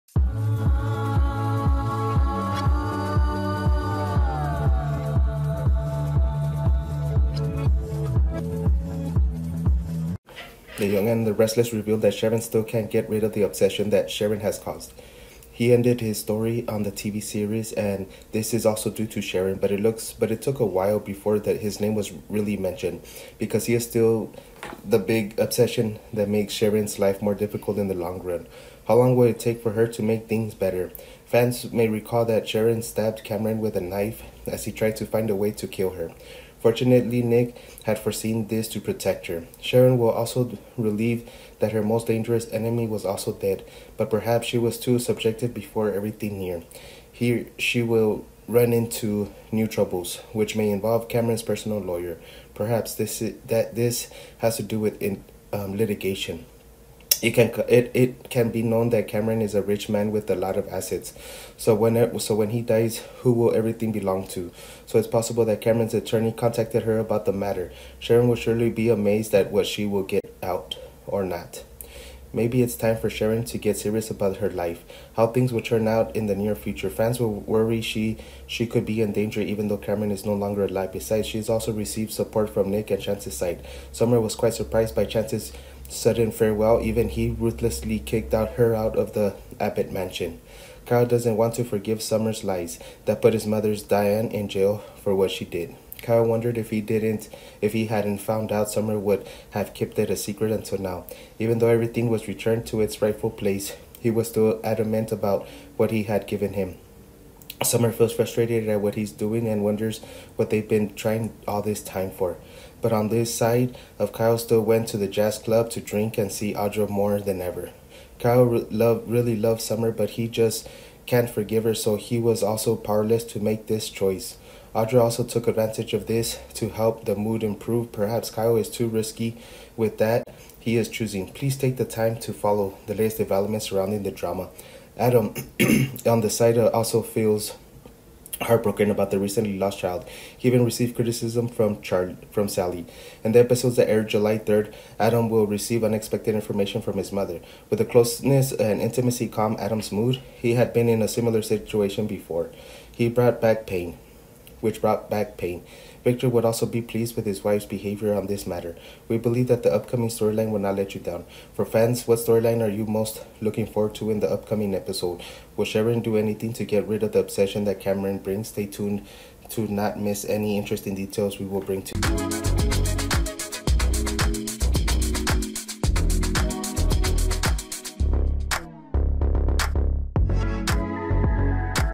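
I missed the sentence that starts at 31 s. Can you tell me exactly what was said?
Fans may recall that Sharon stabbed Cameron with a knife as he tried to find a way to kill her.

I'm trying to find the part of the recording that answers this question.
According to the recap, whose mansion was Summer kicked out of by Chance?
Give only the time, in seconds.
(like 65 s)
89 s.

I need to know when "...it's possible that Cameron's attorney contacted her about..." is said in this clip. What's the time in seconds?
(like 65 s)
64 s.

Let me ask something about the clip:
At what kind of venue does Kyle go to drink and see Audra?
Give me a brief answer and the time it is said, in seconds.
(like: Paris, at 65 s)
jazz club, at 115 s.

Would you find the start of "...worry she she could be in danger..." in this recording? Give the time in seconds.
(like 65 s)
77 s.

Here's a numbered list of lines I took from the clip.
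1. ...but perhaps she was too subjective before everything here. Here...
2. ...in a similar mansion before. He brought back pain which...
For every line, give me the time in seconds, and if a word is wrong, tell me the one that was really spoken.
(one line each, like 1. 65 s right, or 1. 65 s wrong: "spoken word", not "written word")
1. 43 s right
2. 150 s wrong: "situation", not "mansion".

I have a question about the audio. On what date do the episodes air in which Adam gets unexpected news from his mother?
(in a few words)
July 3rd.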